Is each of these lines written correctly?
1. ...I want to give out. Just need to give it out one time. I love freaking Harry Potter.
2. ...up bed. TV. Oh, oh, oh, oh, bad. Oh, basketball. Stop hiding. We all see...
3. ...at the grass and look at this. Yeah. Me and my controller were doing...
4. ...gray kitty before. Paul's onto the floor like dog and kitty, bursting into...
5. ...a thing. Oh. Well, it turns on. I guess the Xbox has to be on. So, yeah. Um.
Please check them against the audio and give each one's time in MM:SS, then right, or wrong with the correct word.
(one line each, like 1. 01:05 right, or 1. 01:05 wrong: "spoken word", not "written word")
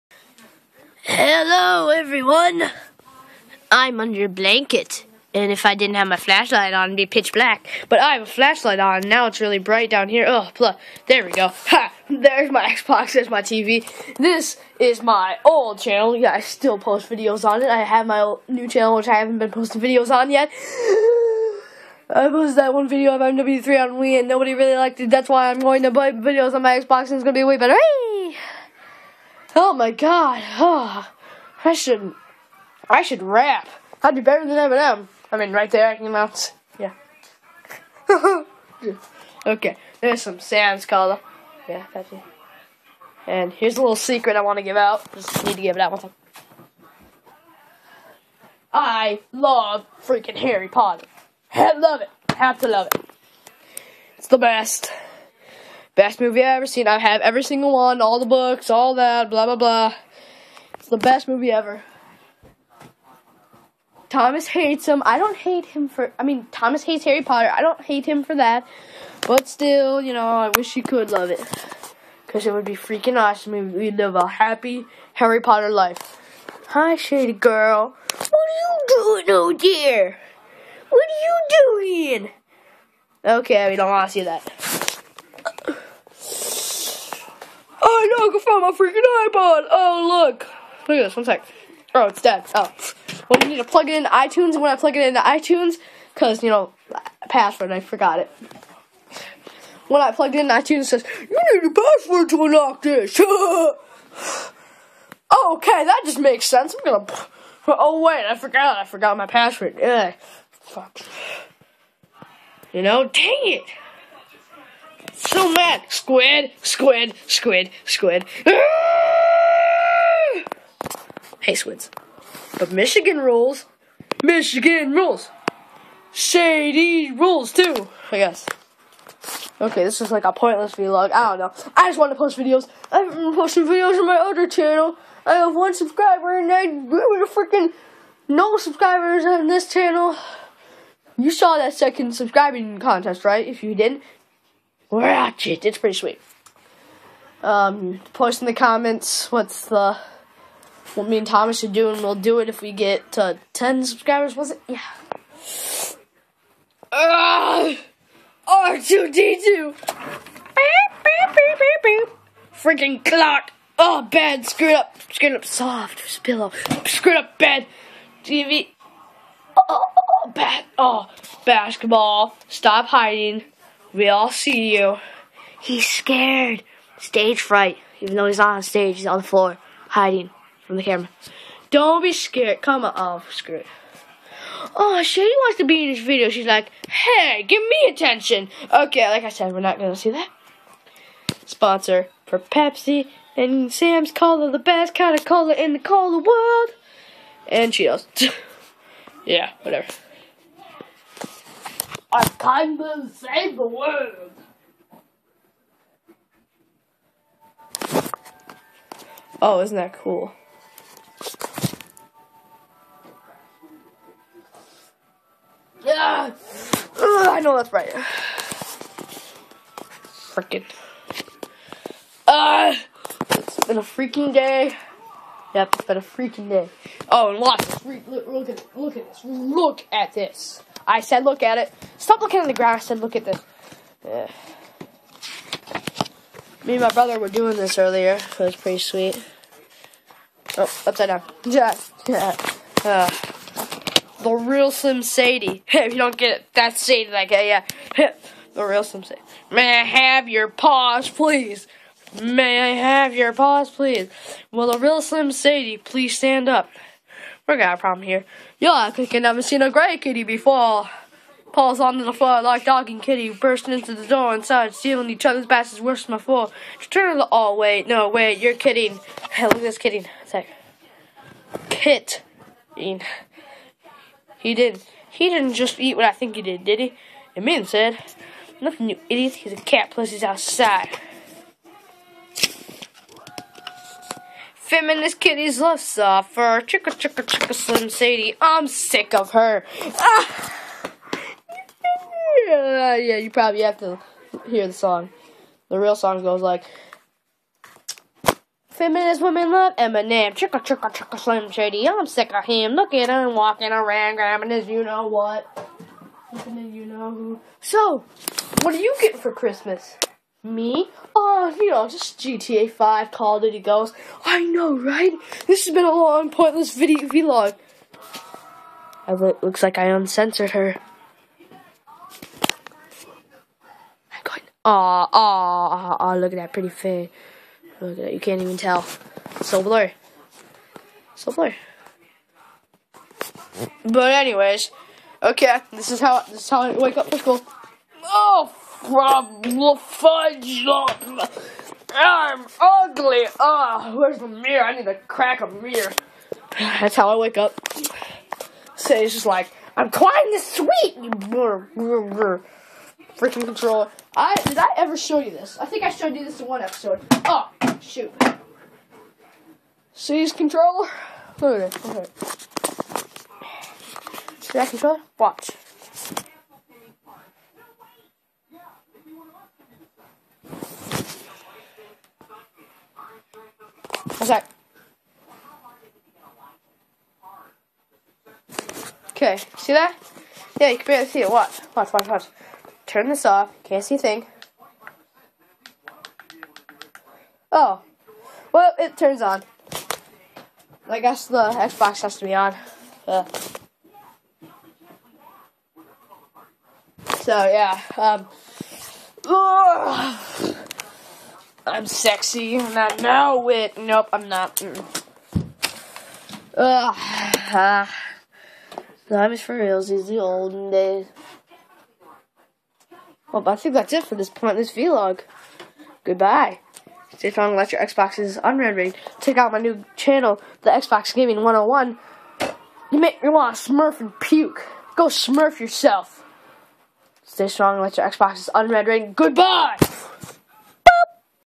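1. 00:44 right
2. 02:47 right
3. 03:52 wrong: "brother", not "controller"
4. 04:19 right
5. 06:23 right.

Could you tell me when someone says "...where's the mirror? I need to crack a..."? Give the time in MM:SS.
05:43.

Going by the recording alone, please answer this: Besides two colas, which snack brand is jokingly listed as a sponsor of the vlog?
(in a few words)
Cheetos.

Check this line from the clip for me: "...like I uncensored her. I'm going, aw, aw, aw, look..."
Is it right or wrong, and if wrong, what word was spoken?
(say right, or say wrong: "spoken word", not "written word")
right.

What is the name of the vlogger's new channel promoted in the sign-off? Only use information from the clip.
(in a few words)
Xbox Gaming 101.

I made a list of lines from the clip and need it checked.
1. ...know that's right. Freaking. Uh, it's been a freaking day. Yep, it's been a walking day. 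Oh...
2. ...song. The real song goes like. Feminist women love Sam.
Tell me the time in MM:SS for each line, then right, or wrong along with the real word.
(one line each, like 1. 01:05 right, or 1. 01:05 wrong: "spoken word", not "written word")
1. 03:37 wrong: "freaking", not "walking"
2. 04:54 wrong: "Eminem", not "Sam".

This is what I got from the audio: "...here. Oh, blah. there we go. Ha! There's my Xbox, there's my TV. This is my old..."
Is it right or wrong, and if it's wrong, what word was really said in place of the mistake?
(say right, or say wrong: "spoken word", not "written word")
right.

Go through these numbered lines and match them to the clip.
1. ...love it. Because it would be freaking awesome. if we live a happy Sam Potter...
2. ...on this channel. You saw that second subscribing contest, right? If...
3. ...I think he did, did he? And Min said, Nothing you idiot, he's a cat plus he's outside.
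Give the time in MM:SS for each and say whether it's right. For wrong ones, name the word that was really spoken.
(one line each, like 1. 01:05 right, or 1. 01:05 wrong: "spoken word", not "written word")
1. 01:11 wrong: "Harry", not "Sam"
2. 02:19 right
3. 04:36 right.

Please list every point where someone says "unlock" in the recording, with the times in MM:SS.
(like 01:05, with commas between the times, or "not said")
01:42.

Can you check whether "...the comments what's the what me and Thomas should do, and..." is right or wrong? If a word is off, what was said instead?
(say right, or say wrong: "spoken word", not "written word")
right.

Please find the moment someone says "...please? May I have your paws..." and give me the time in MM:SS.
04:11.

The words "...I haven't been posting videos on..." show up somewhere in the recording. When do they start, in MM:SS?
00:19.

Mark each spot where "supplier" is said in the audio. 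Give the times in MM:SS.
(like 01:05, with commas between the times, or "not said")
not said.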